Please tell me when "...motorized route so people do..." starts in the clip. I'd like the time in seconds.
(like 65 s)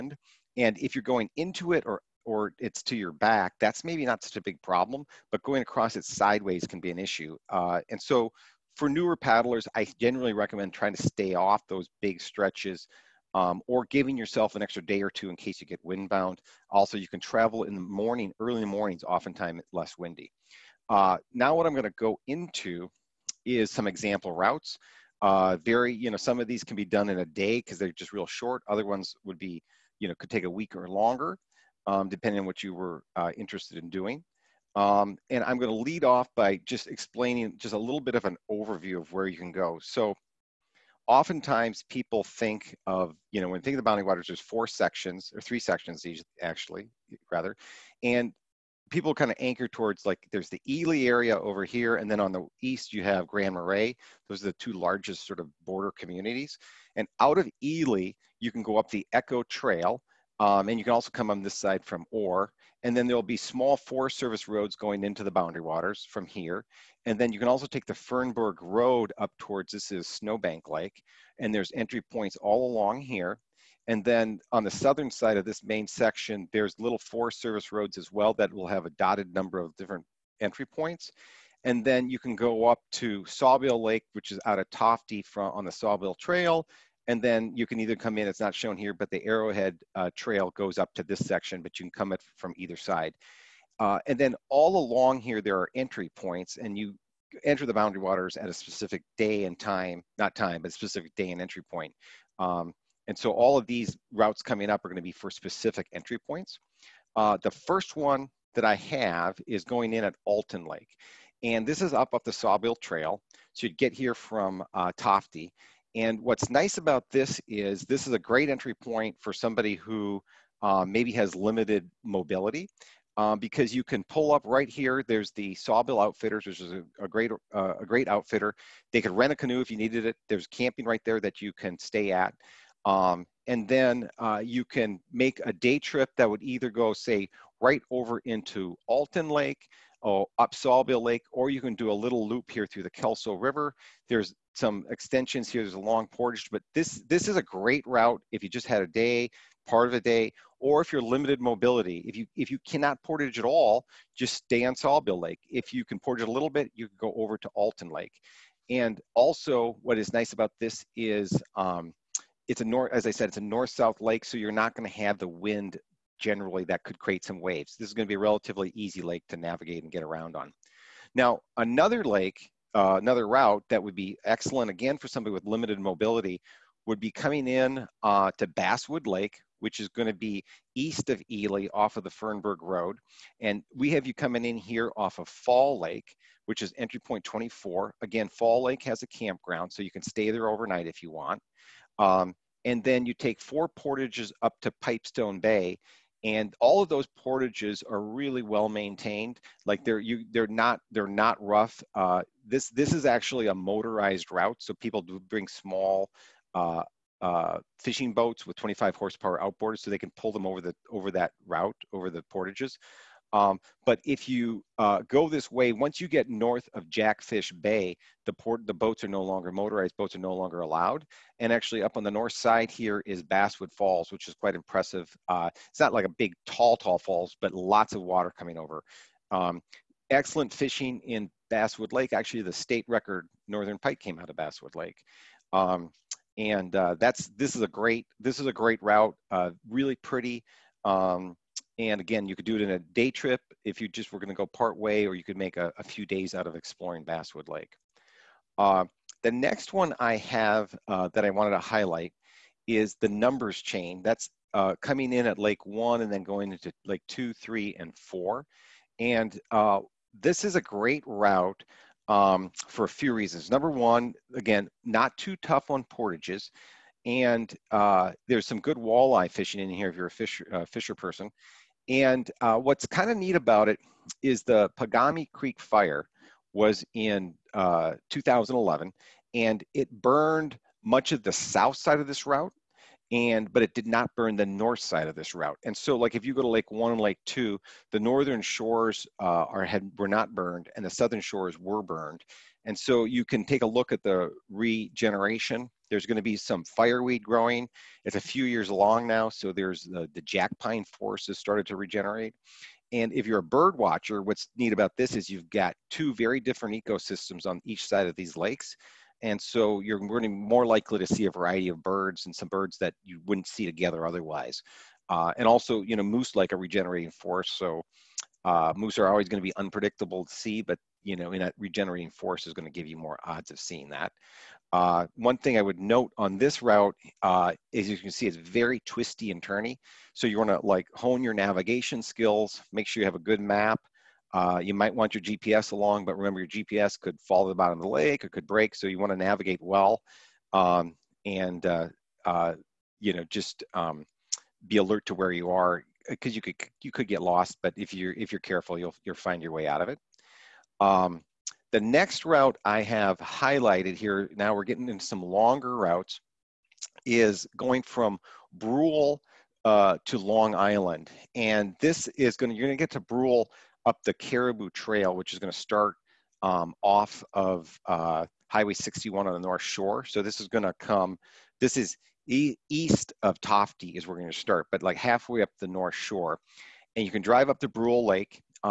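203 s.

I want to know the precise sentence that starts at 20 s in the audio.
Uh, now what I'm gonna go into is some example routes.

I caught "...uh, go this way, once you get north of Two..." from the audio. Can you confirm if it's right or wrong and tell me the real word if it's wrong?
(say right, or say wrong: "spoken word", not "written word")
wrong: "Jackfish", not "Two".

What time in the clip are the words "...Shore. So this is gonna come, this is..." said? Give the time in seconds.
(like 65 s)
369 s.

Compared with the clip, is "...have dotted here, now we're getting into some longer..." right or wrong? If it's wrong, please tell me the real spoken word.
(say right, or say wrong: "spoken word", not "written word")
wrong: "highlighted", not "dotted".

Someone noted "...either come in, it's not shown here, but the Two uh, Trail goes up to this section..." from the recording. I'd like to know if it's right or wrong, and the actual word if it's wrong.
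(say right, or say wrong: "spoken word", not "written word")
wrong: "Arrowhead", not "Two".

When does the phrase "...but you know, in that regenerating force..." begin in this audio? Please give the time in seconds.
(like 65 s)
320 s.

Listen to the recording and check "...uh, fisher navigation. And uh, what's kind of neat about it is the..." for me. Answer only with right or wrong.
wrong.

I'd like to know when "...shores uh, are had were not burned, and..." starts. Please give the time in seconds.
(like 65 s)
288 s.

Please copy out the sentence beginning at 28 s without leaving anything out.
Other ones would be, you know, could take a week or longer um, depending on what you were uh, interested in doing.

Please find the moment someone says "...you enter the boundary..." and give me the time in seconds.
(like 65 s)
96 s.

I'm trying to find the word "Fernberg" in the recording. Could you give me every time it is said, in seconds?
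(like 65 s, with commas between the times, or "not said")
67 s, 182 s.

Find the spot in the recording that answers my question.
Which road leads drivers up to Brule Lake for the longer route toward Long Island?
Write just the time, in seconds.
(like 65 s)
364 s.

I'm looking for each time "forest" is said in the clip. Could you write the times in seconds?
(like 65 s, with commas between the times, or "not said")
63 s, 76 s, 300 s, 317 s.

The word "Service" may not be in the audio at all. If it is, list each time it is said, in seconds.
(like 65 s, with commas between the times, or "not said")
64 s, 77 s.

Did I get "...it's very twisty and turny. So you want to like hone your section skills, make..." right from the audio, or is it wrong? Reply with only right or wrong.
wrong.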